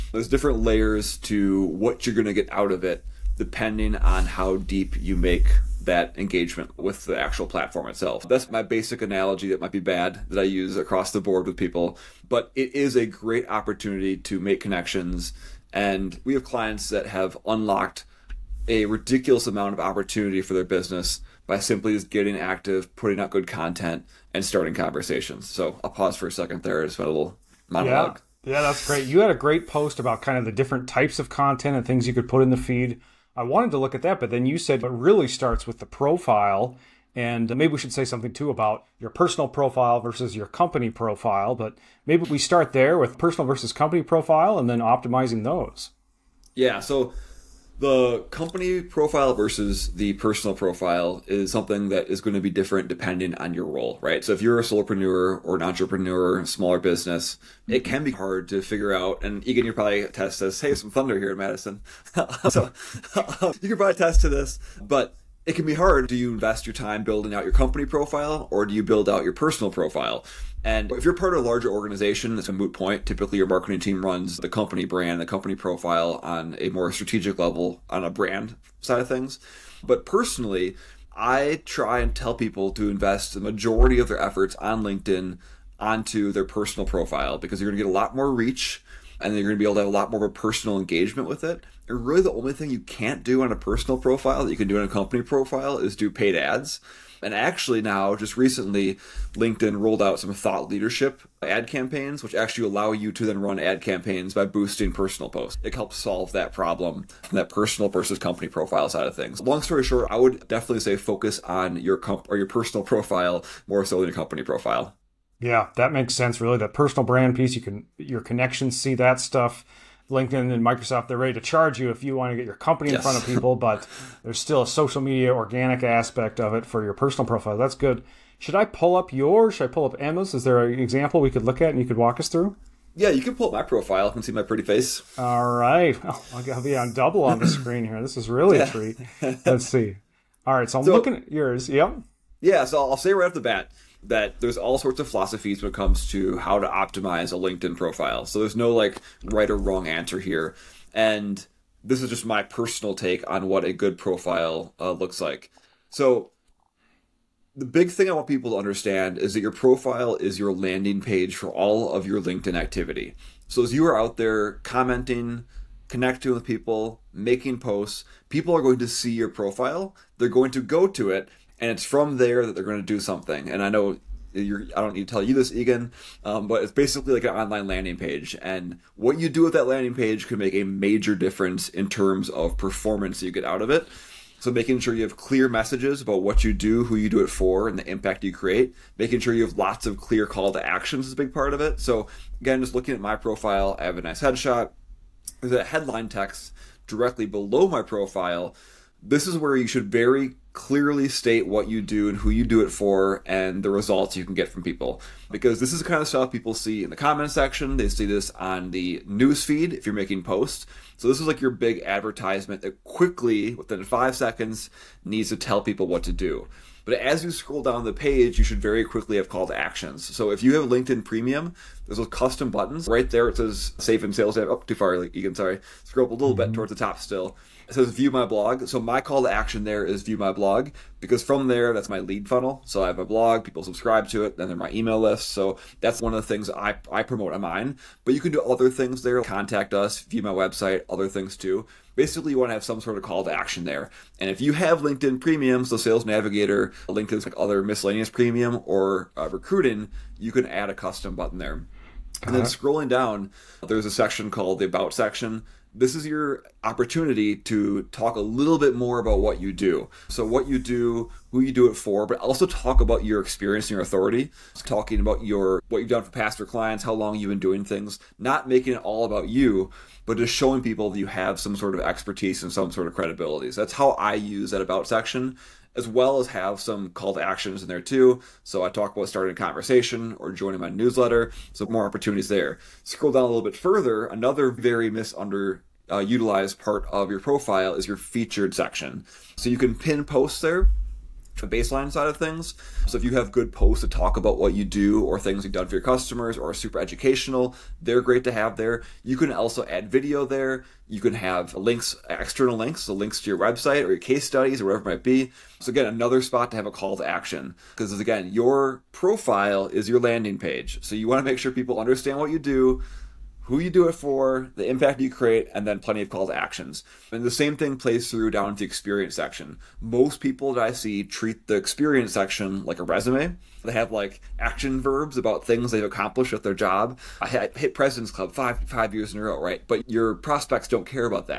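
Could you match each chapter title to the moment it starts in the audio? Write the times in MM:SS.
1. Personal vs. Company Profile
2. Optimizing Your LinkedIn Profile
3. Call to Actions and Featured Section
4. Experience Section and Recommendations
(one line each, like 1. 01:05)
1. 00:32
2. 02:22
3. 03:39
4. 05:19.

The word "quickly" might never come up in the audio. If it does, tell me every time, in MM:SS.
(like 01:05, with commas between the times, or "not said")
03:32, 03:38.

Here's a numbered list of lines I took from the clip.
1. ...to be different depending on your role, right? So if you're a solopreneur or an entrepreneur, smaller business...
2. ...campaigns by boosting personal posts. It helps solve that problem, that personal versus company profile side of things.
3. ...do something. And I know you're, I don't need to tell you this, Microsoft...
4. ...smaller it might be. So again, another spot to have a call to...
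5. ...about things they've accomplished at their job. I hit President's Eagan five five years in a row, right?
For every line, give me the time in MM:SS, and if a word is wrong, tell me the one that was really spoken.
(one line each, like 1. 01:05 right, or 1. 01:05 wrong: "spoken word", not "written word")
1. 00:52 right
2. 01:43 right
3. 02:52 wrong: "Eagan", not "Microsoft"
4. 05:04 wrong: "whatever", not "smaller"
5. 05:25 wrong: "Club", not "Eagan".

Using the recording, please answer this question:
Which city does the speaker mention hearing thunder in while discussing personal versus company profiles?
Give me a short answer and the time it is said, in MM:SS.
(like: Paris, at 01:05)
Madison, at 01:01.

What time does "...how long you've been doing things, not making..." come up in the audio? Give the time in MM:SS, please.
04:26.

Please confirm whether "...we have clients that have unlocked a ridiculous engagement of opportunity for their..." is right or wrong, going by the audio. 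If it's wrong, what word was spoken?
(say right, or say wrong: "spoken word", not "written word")
wrong: "amount", not "engagement".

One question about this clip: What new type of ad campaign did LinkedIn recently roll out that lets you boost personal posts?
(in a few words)
Thought leadership ad campaigns.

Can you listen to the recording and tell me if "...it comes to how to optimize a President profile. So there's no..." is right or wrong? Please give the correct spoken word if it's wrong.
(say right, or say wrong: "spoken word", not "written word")
wrong: "LinkedIn", not "President".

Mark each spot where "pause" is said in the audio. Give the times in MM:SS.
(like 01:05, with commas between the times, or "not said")
00:25.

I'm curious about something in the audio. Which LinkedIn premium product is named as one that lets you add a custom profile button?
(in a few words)
Sales Navigator.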